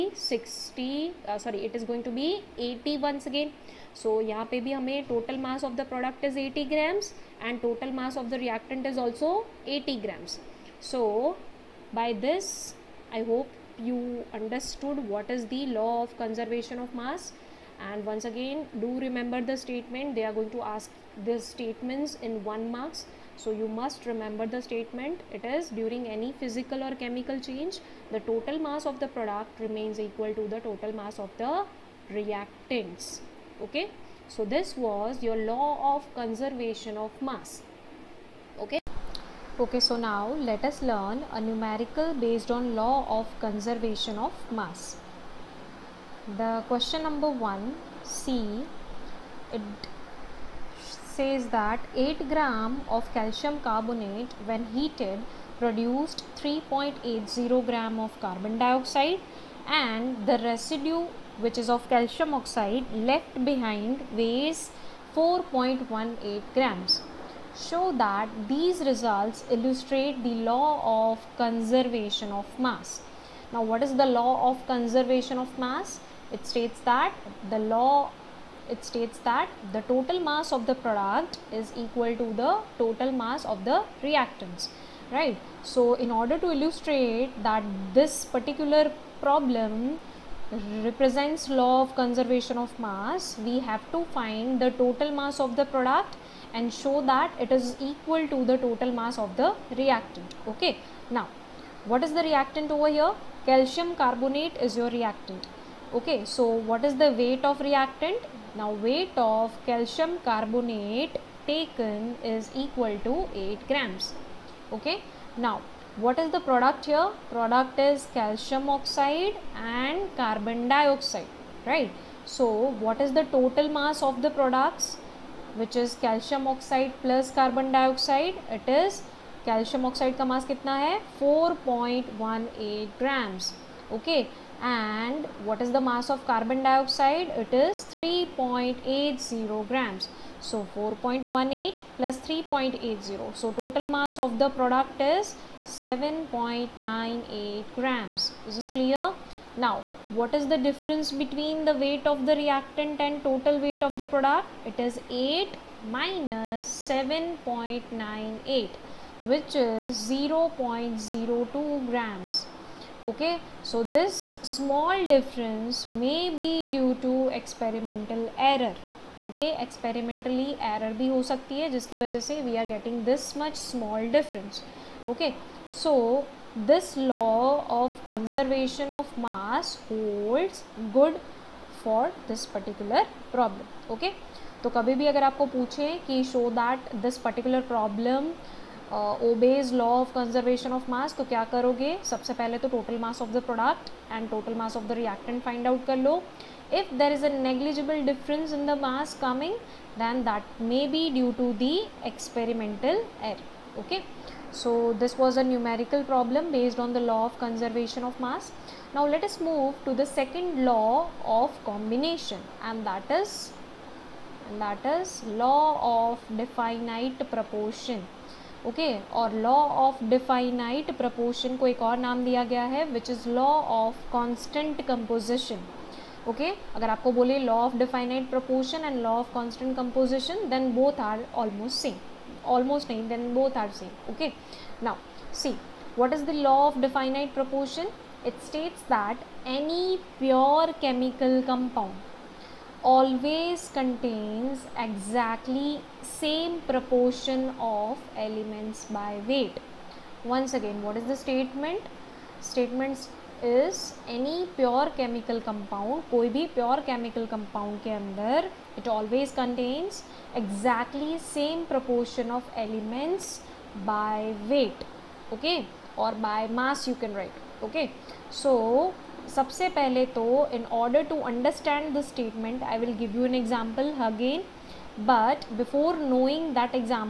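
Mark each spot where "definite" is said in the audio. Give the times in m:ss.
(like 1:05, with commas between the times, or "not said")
3:36, 3:56.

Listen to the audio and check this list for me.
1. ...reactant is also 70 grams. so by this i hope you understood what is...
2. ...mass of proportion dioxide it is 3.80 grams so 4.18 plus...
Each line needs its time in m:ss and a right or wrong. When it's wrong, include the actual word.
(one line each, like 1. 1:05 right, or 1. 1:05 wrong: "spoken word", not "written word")
1. 0:08 wrong: "80", not "70"
2. 2:15 wrong: "carbon", not "proportion".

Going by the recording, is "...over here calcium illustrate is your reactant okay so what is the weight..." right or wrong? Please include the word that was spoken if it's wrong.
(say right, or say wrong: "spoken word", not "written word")
wrong: "carbonate", not "illustrate".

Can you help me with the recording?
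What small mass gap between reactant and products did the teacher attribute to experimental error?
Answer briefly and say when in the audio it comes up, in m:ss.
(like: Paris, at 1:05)
0.02 grams, at 2:40.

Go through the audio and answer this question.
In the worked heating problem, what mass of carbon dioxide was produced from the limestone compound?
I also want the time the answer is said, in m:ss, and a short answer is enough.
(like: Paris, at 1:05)
3.80 grams, at 0:56.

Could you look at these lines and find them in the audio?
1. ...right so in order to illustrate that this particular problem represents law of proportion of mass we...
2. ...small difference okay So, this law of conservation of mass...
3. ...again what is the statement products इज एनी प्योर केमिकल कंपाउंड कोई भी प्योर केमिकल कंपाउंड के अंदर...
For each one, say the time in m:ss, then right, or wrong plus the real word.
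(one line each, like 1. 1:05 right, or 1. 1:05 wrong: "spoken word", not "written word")
1. 1:25 wrong: "conservation", not "proportion"
2. 2:53 right
3. 4:10 wrong: "statements", not "products".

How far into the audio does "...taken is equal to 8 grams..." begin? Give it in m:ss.
1:51.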